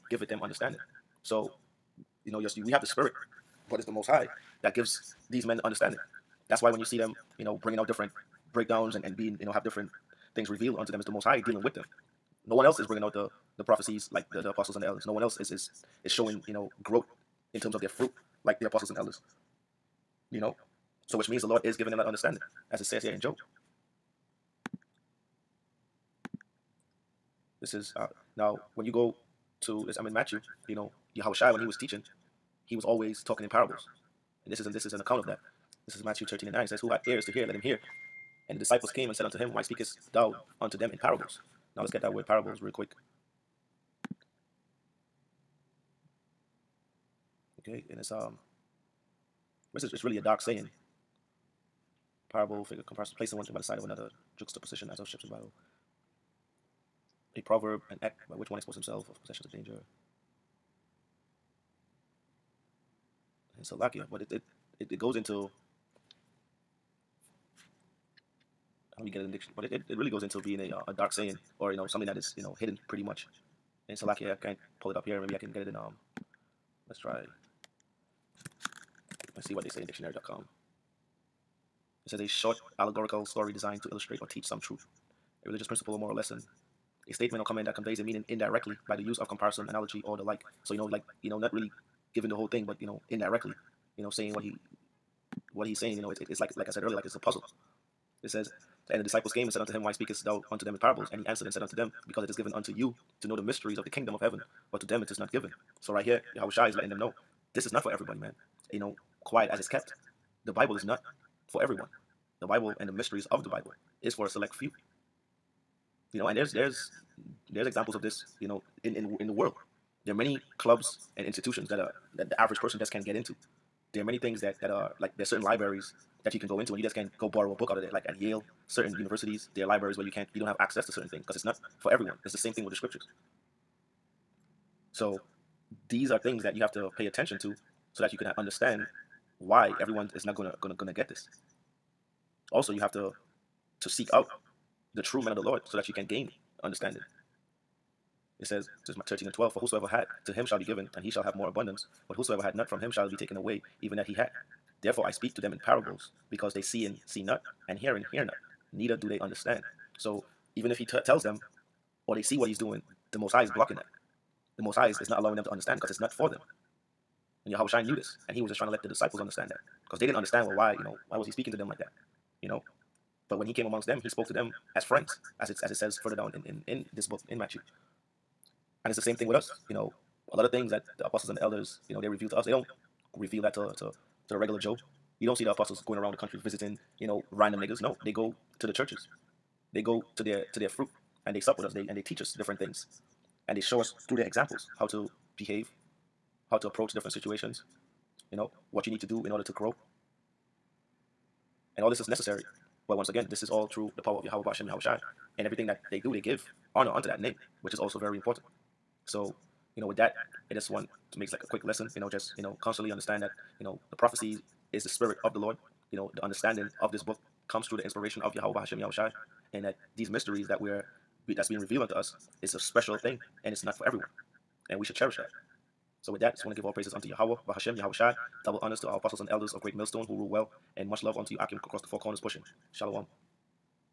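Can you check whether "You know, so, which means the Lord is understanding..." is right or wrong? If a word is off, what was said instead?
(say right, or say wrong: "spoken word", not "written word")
wrong: "giving", not "understanding".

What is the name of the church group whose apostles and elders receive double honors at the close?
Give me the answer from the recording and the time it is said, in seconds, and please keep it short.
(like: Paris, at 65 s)
Great Millstone, at 229 s.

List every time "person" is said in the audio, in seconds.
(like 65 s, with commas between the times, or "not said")
122 s.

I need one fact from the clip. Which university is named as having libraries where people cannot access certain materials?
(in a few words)
Yale.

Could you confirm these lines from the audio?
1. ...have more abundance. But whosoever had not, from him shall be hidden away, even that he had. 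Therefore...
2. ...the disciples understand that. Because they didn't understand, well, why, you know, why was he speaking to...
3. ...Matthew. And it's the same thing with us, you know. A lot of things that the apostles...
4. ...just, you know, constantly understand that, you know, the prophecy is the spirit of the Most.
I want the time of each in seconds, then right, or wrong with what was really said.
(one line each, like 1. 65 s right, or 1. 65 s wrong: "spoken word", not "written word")
1. 151 s wrong: "taken", not "hidden"
2. 168 s right
3. 177 s right
4. 212 s wrong: "Lord", not "Most".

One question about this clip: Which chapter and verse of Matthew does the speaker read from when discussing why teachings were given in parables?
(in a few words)
Matthew 13:9.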